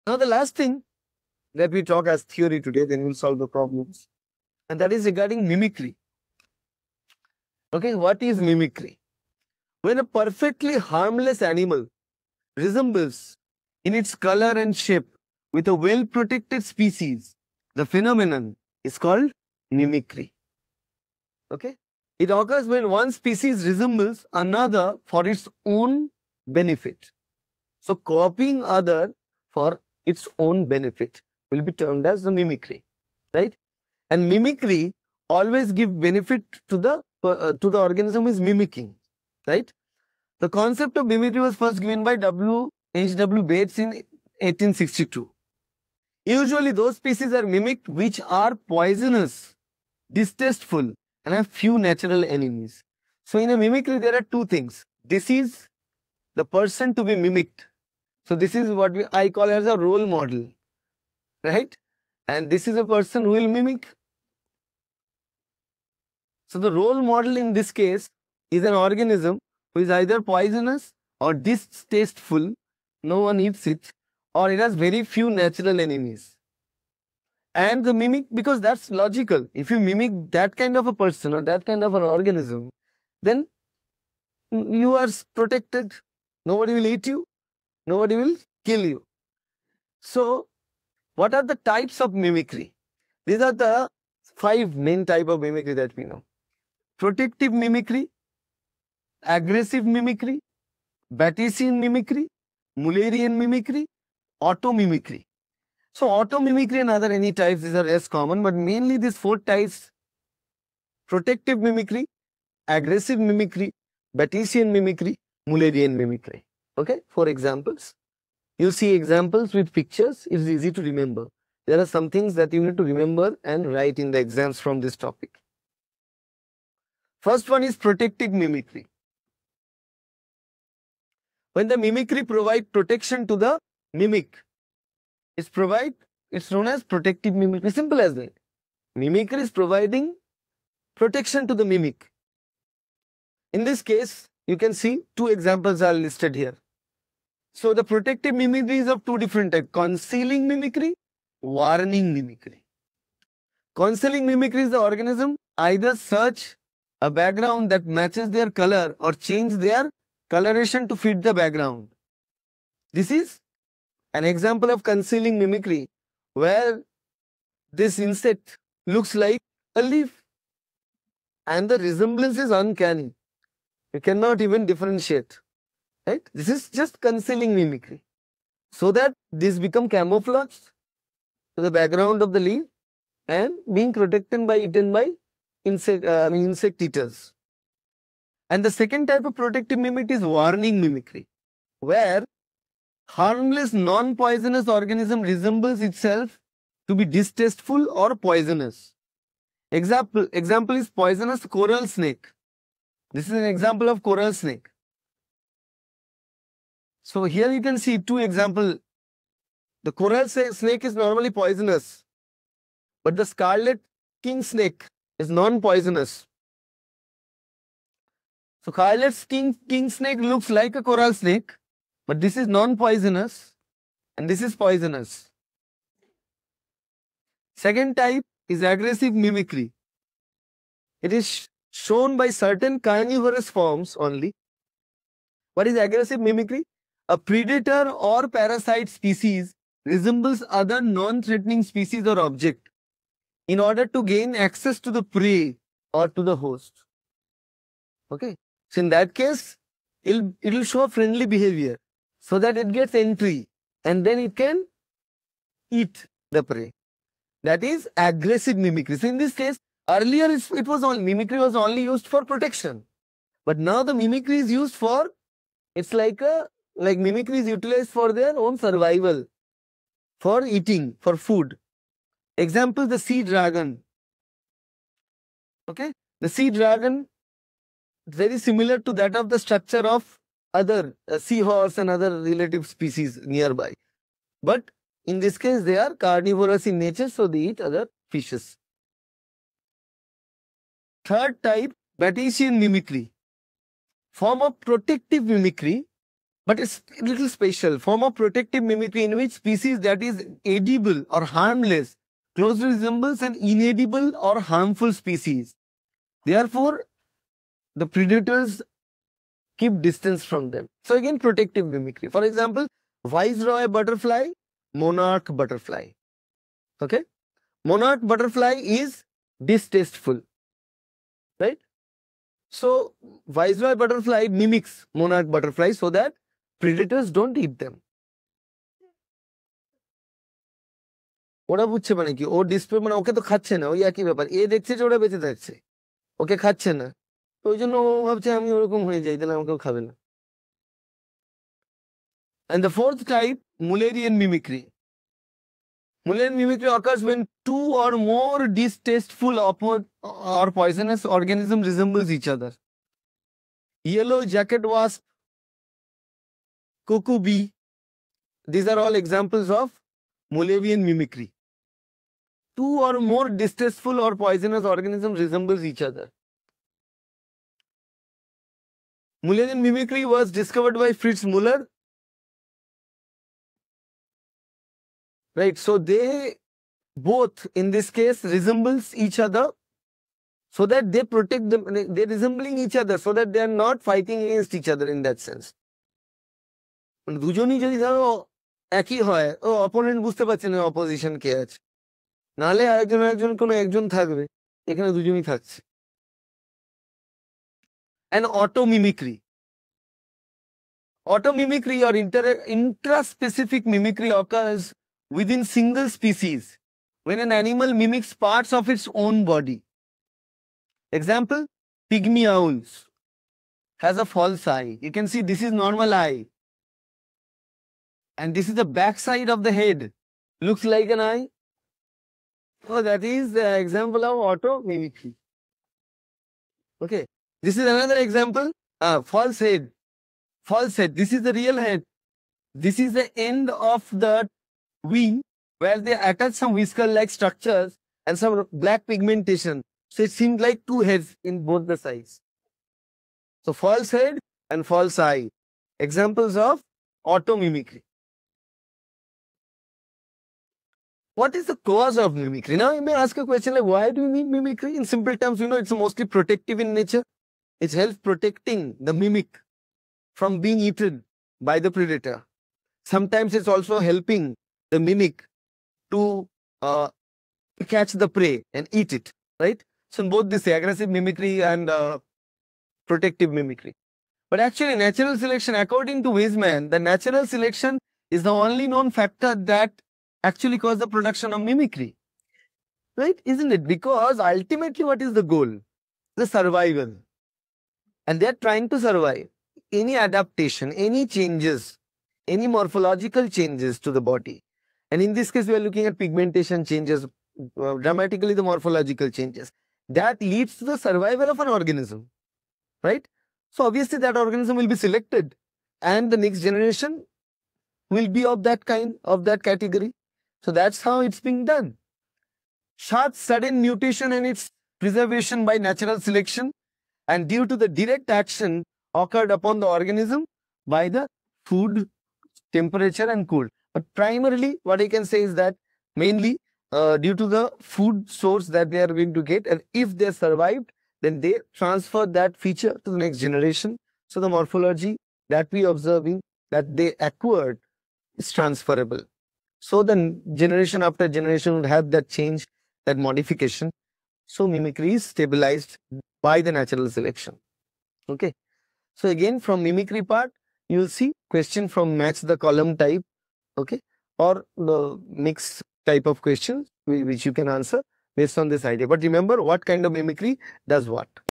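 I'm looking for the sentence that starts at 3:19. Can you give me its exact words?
Example, example is poisonous coral snake.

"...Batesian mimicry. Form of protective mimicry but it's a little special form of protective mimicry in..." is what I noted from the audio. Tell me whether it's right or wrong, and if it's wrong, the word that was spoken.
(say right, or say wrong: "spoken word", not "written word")
right.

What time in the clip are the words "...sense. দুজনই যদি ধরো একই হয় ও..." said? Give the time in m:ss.
6:25.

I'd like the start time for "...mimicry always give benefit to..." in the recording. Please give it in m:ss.
0:34.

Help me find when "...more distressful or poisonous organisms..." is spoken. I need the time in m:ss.
6:02.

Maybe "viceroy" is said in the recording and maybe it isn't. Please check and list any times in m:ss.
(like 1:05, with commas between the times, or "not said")
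5:13, 5:23.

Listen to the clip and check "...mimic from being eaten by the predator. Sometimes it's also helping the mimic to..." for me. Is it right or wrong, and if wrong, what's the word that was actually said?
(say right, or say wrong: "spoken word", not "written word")
right.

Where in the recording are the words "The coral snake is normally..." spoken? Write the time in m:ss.
3:29.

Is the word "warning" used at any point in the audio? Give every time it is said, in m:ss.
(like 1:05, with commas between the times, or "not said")
2:31, 3:10.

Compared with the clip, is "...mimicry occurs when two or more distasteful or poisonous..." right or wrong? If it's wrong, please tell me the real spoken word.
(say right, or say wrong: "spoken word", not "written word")
right.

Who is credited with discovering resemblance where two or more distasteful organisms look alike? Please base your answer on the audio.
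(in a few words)
Fritz Muller.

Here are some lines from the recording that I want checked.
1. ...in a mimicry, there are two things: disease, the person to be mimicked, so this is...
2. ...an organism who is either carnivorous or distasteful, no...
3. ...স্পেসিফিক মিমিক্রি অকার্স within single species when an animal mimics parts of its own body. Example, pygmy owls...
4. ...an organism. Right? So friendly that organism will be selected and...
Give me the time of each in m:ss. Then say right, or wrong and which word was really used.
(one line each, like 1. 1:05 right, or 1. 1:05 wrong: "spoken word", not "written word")
1. 0:53 right
2. 1:08 wrong: "poisonous", not "carnivorous"
3. 6:43 right
4. 8:21 wrong: "obviously", not "friendly".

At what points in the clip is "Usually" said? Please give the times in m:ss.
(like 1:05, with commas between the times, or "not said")
0:46.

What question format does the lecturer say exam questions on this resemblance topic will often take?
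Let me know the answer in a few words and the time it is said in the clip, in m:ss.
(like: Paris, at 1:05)
match the column, at 9:11.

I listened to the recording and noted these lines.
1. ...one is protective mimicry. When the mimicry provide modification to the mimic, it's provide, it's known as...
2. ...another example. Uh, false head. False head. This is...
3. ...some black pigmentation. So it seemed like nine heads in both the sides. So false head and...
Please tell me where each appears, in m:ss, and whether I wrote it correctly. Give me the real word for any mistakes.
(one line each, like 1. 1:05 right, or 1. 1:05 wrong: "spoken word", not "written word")
1. 2:07 wrong: "protection", not "modification"
2. 7:07 right
3. 7:18 wrong: "two", not "nine".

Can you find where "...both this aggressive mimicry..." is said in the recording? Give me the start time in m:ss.
7:50.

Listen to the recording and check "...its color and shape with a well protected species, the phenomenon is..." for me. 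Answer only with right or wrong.
right.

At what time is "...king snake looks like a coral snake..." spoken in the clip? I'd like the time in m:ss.
3:39.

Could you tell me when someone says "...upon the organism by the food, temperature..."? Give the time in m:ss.
8:39.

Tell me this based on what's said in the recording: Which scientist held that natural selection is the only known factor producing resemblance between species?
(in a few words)
Weismann.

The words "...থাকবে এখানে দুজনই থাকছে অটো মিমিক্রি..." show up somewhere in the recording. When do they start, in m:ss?
6:33.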